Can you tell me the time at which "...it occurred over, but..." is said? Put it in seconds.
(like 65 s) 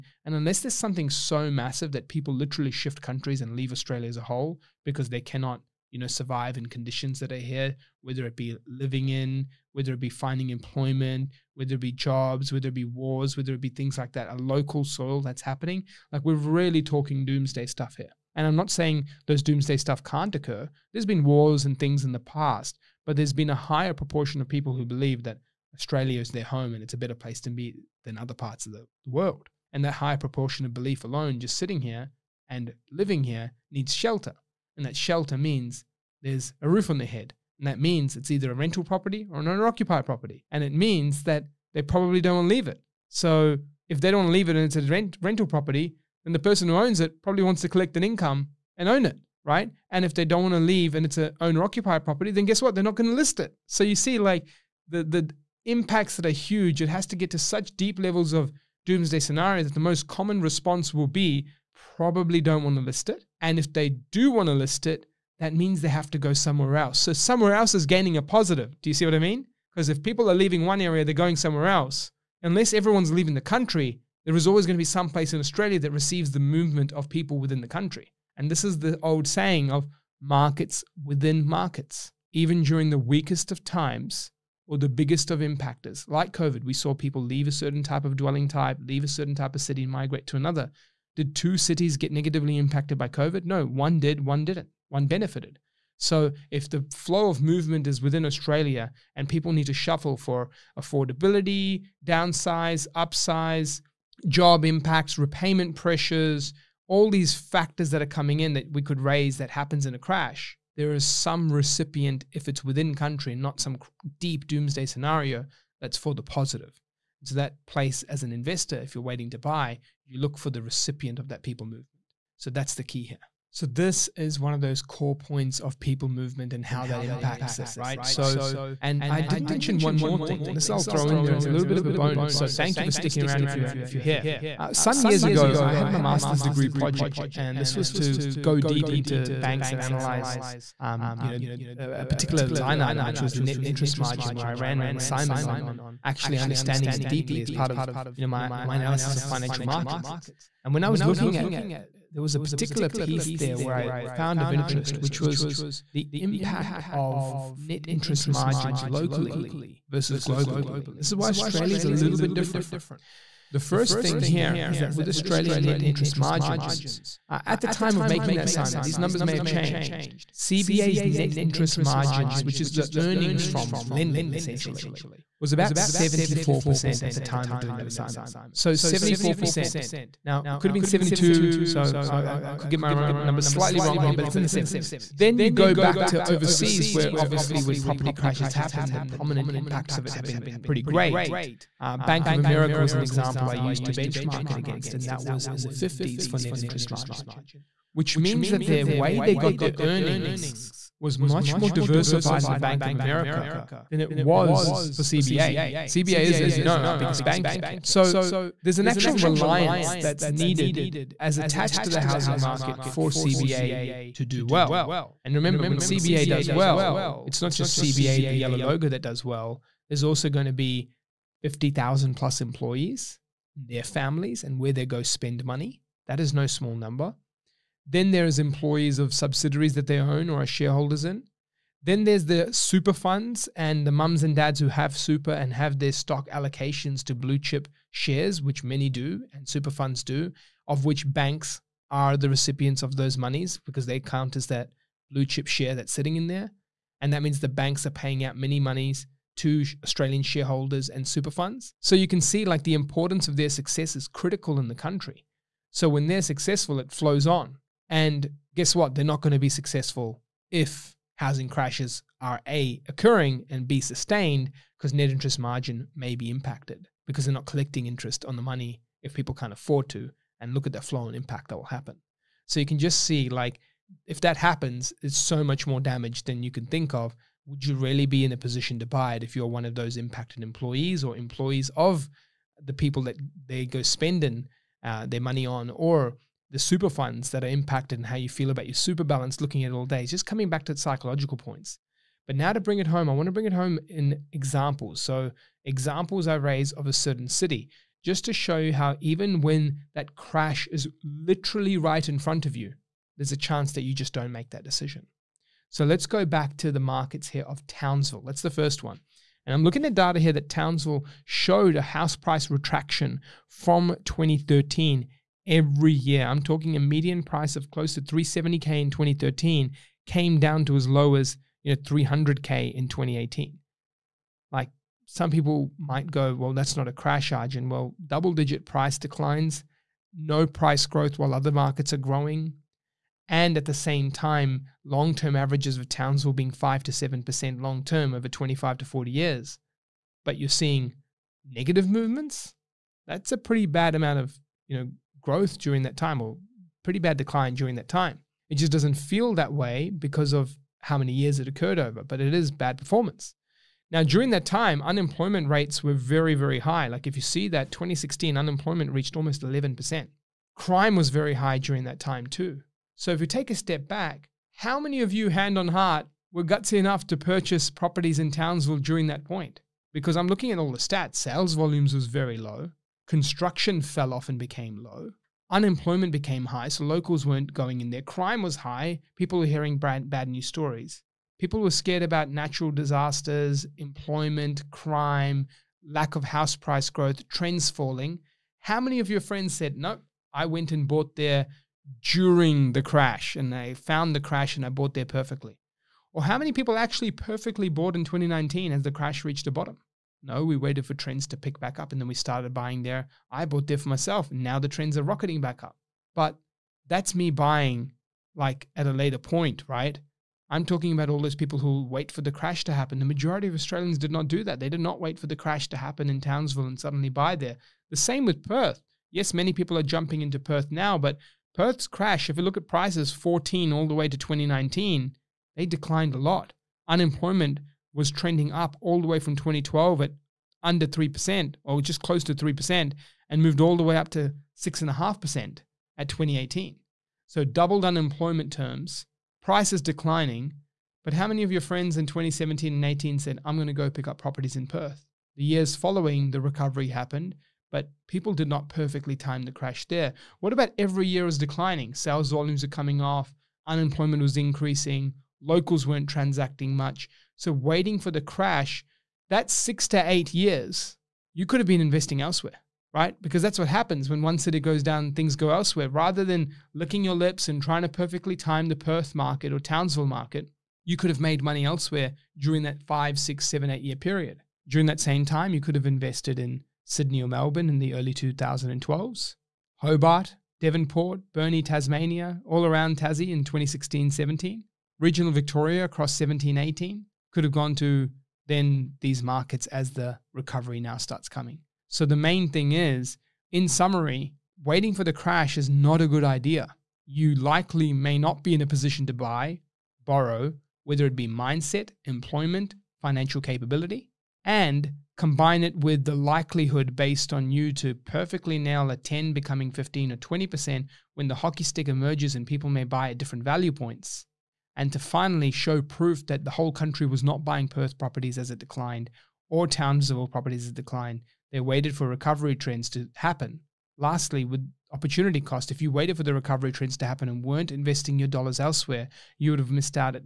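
351 s.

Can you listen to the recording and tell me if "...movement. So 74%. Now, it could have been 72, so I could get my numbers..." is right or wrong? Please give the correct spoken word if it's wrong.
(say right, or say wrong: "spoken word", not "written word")
wrong: "assignment", not "movement".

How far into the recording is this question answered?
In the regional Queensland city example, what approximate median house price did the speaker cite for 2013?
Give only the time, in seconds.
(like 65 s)
318 s.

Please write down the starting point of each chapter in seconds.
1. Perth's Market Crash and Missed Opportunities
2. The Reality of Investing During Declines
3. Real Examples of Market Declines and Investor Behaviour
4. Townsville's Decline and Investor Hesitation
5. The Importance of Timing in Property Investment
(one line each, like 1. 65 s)
1. 254 s
2. 369 s
3. 126 s
4. 189 s
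5. 516 s.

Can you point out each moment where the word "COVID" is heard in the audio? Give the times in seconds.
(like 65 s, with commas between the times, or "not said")
86 s, 93 s.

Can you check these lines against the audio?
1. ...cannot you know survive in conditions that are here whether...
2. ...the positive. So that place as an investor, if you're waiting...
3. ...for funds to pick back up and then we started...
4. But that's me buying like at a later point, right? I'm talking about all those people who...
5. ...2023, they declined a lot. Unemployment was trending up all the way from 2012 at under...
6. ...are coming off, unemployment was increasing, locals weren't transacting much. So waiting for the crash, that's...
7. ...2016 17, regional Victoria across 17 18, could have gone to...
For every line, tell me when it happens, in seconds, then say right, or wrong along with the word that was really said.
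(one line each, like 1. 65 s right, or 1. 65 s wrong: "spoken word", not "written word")
1. 5 s right
2. 116 s right
3. 400 s wrong: "trends", not "funds"
4. 406 s right
5. 424 s wrong: "2019", not "2023"
6. 452 s right
7. 483 s right.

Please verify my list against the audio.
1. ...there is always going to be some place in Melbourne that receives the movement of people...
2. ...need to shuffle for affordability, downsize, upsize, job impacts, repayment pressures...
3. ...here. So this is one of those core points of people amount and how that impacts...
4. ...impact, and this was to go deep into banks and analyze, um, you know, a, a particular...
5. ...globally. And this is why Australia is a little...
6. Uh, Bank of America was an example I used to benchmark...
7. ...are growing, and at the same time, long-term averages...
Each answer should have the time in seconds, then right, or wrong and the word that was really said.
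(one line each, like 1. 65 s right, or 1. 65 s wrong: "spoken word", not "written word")
1. 74 s wrong: "Australia", not "Melbourne"
2. 99 s right
3. 123 s wrong: "movement", not "amount"
4. 136 s wrong: "project", not "impact"
5. 160 s right
6. 191 s right
7. 331 s right.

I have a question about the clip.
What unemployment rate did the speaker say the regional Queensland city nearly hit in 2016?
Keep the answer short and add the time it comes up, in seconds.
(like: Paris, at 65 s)
11%, at 359 s.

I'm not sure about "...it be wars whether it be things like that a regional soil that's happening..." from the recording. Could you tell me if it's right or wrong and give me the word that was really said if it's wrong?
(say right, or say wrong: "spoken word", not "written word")
wrong: "local", not "regional".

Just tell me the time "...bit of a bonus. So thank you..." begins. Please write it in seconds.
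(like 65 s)
131 s.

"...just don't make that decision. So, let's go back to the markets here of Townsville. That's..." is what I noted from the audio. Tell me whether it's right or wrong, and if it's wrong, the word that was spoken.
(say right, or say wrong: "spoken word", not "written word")
right.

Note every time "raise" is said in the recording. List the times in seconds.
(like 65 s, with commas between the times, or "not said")
109 s, 296 s.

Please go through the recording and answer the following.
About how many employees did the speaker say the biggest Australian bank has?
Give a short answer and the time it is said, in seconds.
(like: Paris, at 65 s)
50,000, at 221 s.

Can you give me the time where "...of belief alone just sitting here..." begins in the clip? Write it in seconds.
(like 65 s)
30 s.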